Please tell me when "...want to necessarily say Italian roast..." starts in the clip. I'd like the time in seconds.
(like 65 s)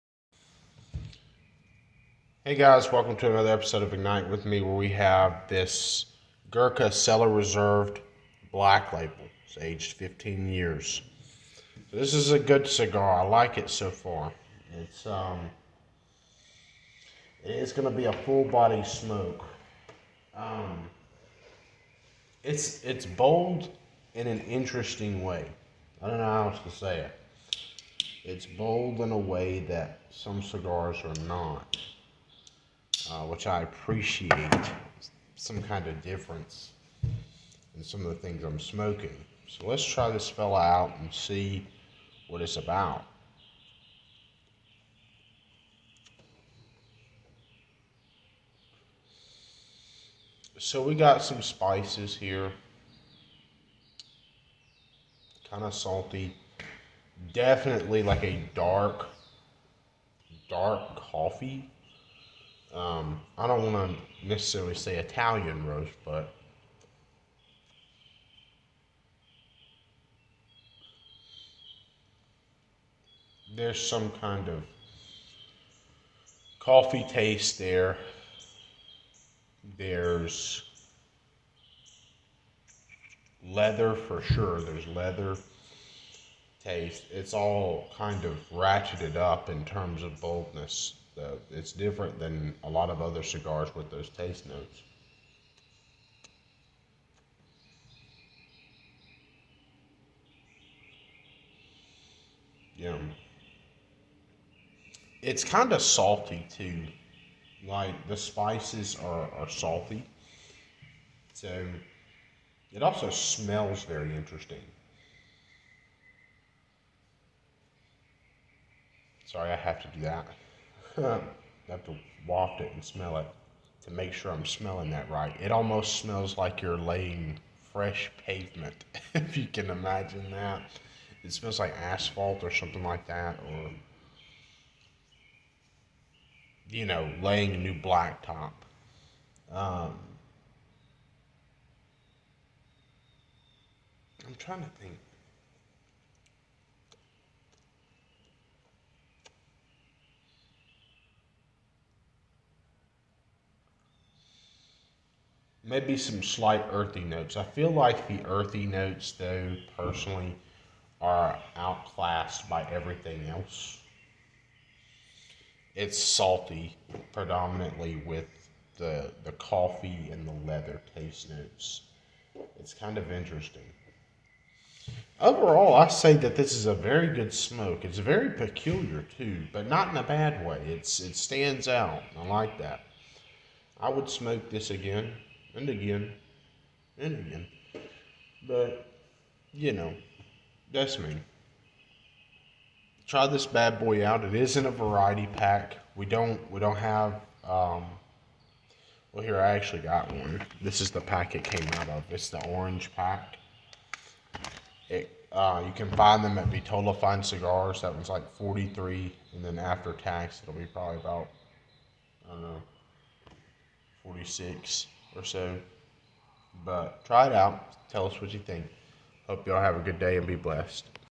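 63 s.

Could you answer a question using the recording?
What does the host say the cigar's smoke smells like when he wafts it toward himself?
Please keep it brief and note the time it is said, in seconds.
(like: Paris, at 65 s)
Fresh pavement, at 127 s.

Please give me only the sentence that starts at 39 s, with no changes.
So let's try this fella out and see what it's about.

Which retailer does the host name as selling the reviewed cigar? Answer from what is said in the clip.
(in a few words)
Vitola Fine Cigars.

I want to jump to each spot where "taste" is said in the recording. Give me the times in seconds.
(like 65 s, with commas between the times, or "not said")
77 s, 86 s, 94 s, 170 s.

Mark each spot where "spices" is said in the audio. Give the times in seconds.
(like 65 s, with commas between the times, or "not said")
51 s, 108 s.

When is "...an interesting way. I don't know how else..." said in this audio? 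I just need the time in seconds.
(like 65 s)
24 s.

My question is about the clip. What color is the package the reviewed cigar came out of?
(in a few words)
Orange.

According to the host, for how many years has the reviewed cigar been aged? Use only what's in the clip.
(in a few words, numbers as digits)
15.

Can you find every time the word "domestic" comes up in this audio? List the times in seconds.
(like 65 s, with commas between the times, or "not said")
not said.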